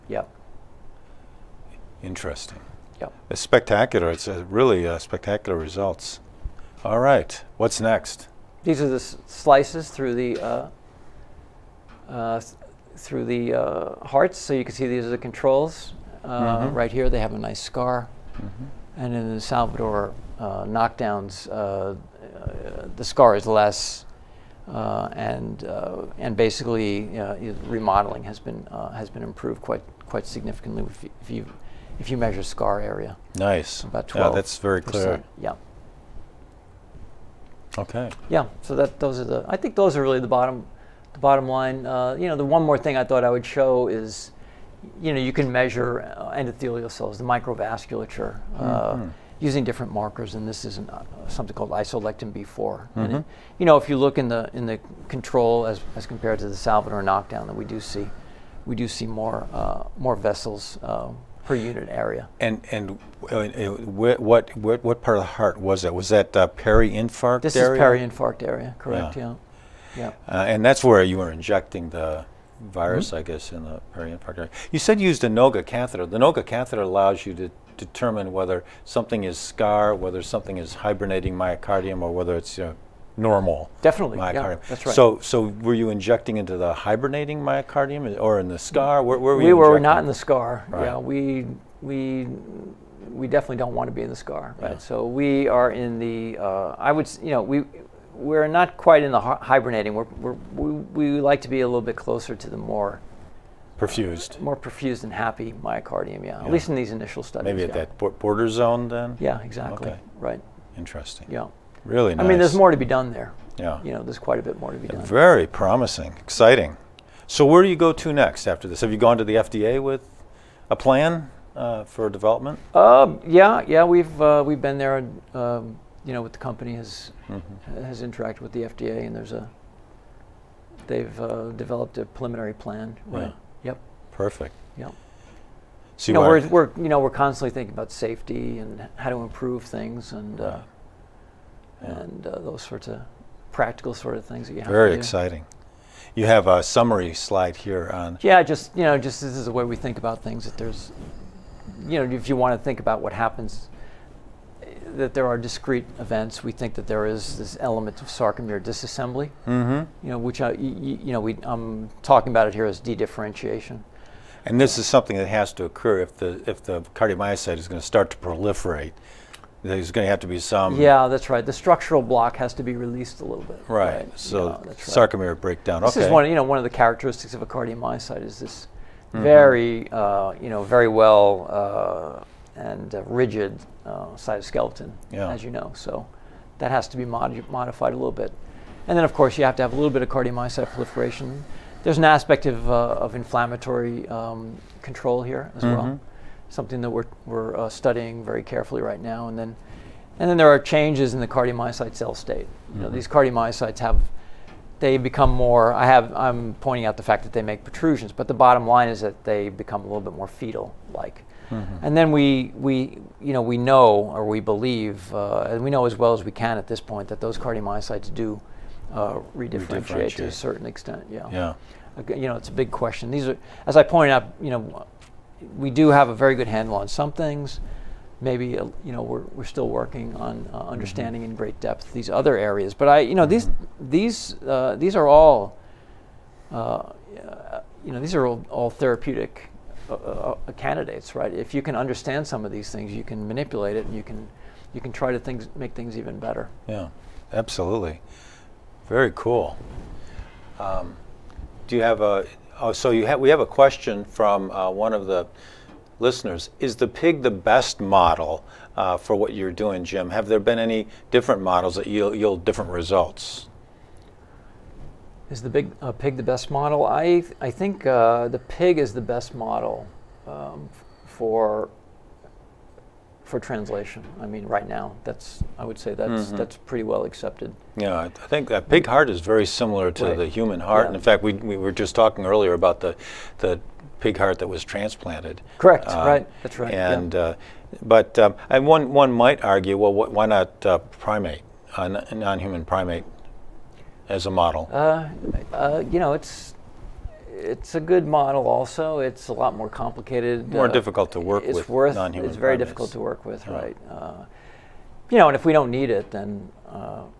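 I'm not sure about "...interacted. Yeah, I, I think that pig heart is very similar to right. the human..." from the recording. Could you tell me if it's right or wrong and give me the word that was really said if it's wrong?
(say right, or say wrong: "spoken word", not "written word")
wrong: "accepted", not "interacted".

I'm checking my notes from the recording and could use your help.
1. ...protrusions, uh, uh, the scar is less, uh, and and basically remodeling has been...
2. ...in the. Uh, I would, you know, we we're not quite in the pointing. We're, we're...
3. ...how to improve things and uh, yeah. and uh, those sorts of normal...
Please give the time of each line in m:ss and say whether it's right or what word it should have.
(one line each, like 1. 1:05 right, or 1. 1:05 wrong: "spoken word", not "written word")
1. 0:20 wrong: "knockdowns", not "protrusions"
2. 1:35 wrong: "hibernating", not "pointing"
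3. 2:18 wrong: "practical", not "normal".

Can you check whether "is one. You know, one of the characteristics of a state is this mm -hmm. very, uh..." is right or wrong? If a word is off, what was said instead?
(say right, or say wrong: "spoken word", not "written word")
wrong: "cardiomyocyte", not "state".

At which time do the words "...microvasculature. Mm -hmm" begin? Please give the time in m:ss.
0:47.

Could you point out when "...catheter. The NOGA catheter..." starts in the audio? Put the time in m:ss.
1:15.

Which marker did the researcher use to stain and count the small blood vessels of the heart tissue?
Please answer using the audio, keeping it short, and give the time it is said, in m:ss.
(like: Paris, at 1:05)
isolectin B4, at 0:51.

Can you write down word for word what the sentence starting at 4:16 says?
Is the pig the best model uh, for what you're doing, Jim?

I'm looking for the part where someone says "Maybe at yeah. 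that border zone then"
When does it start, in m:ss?
1:47.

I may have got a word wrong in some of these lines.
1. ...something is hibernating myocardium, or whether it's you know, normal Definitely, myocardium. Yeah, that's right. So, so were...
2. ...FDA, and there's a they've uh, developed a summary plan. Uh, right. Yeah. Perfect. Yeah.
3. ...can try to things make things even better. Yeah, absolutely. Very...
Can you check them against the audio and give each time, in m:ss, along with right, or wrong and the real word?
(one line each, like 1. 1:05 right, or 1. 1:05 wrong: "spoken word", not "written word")
1. 1:20 right
2. 2:08 wrong: "preliminary", not "summary"
3. 4:04 right.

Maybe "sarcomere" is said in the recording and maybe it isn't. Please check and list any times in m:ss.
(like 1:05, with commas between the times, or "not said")
2:38, 2:54.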